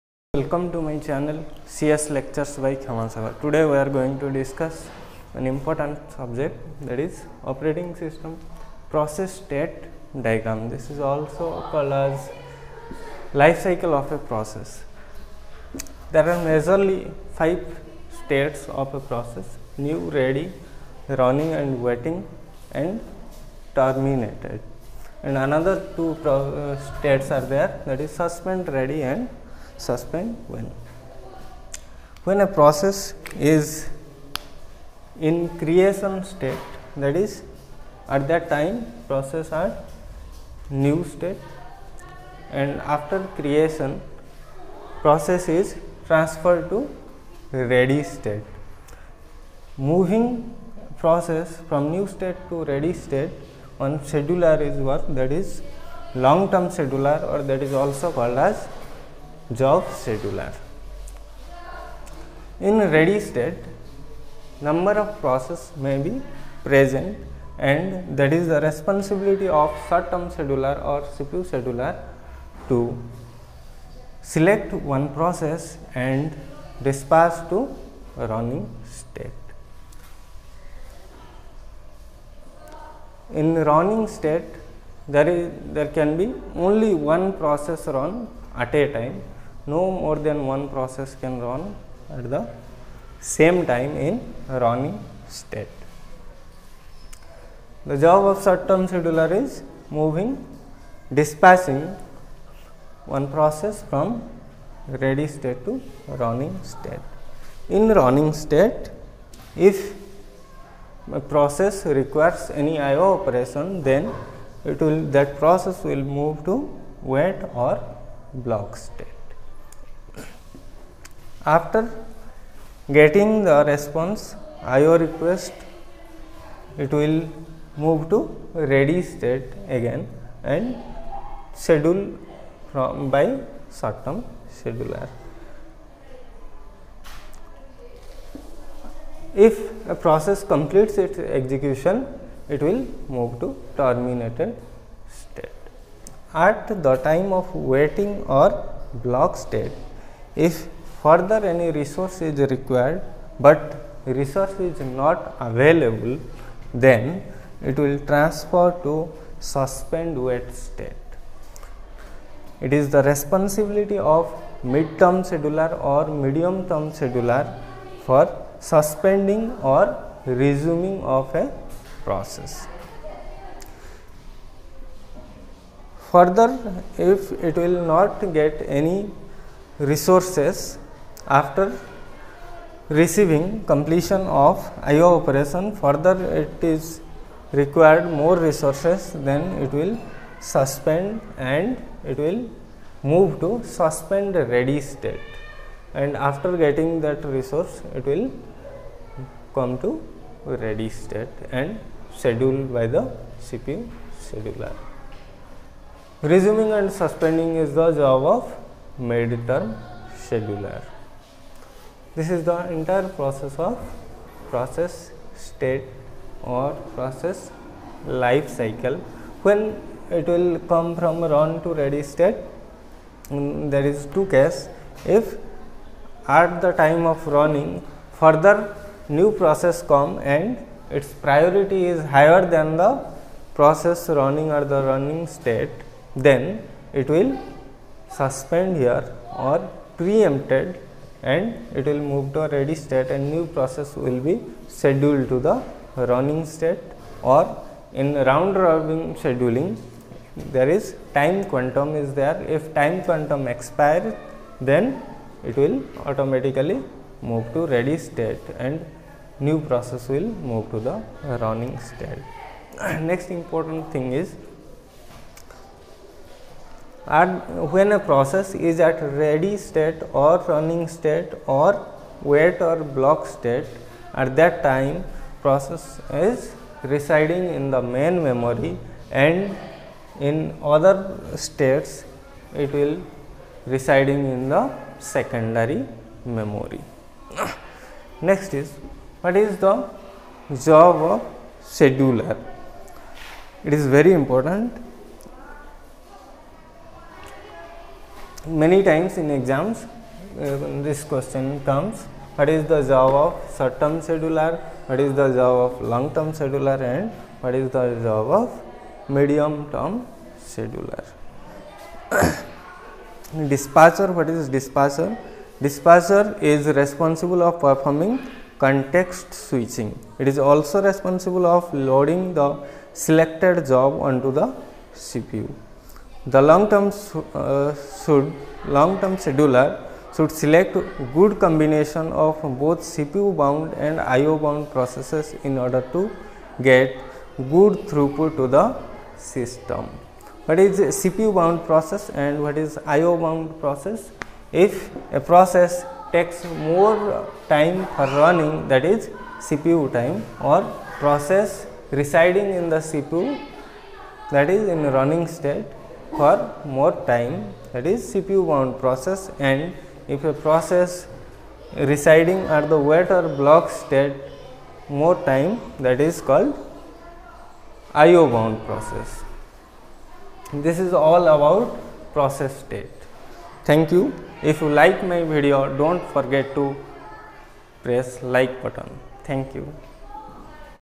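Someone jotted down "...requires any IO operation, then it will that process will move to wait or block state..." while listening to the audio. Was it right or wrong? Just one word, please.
right.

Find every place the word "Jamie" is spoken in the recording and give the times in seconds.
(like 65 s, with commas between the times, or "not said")
not said.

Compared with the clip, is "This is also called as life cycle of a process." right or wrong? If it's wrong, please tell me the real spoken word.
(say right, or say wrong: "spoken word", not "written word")
right.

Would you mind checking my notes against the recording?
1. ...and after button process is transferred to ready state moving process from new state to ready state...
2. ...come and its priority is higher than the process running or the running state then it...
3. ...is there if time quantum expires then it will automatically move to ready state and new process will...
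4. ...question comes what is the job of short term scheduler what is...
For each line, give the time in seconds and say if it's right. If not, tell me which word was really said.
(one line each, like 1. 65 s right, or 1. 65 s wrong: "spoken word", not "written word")
1. 42 s wrong: "creation", not "button"
2. 229 s right
3. 251 s right
4. 301 s right.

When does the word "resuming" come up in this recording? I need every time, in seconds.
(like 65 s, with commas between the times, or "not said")
170 s, 206 s.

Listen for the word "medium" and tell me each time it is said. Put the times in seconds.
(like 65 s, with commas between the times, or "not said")
166 s, 309 s.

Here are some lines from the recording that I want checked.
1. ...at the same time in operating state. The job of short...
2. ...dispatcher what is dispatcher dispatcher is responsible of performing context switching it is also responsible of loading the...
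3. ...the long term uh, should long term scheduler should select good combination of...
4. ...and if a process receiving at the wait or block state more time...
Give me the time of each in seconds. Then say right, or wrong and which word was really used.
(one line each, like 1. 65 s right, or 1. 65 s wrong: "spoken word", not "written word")
1. 92 s wrong: "running", not "operating"
2. 313 s right
3. 326 s right
4. 359 s wrong: "residing", not "receiving".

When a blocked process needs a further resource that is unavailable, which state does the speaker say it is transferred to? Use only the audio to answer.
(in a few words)
suspend wait state.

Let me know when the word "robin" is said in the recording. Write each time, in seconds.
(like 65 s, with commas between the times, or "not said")
248 s.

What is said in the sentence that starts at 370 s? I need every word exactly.
This is all about process state.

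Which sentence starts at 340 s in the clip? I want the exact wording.
What is CPU bound process and what is IO bound process?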